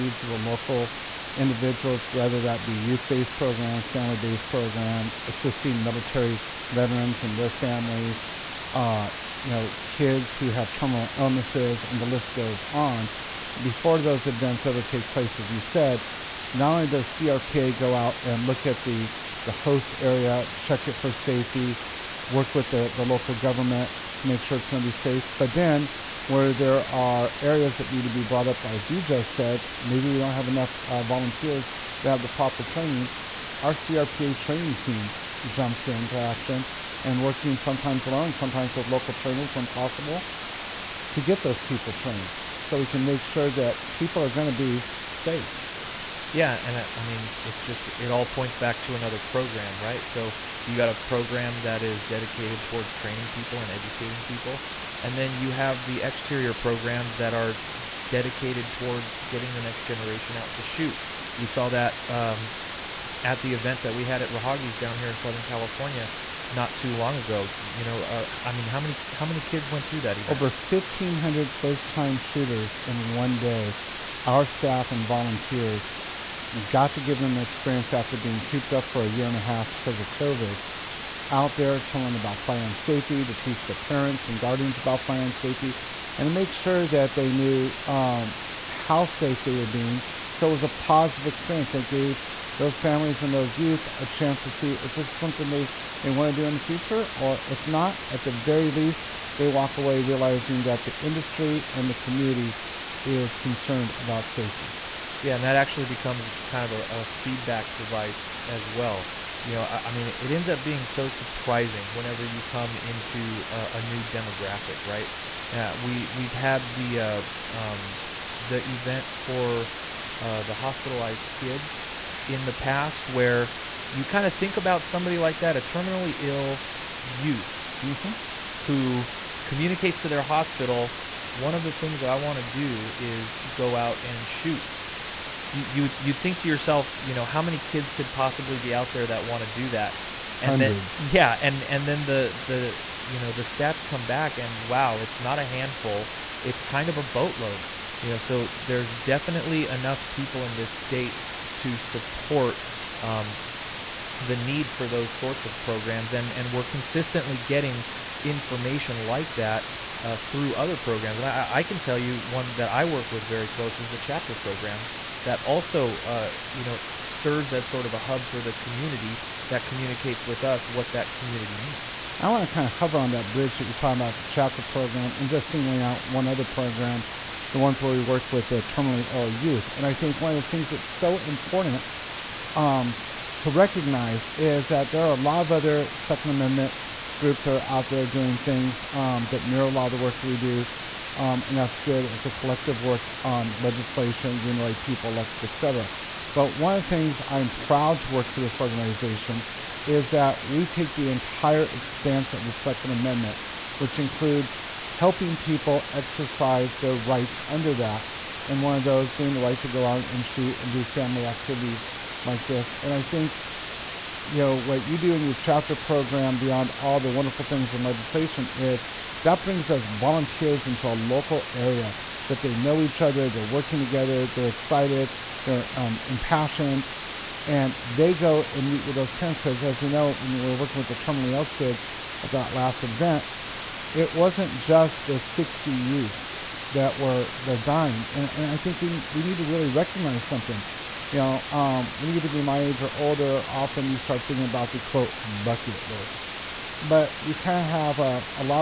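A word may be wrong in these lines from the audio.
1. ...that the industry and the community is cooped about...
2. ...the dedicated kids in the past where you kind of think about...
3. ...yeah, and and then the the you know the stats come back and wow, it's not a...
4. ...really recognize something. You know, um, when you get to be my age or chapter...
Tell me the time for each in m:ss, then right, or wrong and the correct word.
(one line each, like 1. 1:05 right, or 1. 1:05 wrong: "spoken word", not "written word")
1. 1:40 wrong: "concerned", not "cooped"
2. 2:00 wrong: "hospitalized", not "dedicated"
3. 2:21 right
4. 3:59 wrong: "older", not "chapter".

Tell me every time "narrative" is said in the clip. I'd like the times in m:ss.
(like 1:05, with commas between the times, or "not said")
not said.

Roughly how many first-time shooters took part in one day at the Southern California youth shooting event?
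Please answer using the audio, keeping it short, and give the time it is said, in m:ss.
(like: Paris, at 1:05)
Over 1,500, at 1:10.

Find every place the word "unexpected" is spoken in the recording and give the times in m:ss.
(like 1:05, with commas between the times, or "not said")
not said.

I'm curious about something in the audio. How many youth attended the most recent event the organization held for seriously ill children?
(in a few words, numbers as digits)
60.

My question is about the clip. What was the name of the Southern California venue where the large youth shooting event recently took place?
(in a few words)
Raahauge's.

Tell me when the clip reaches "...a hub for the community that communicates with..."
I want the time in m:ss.
2:47.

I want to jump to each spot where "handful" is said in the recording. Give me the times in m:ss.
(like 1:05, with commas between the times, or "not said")
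2:25.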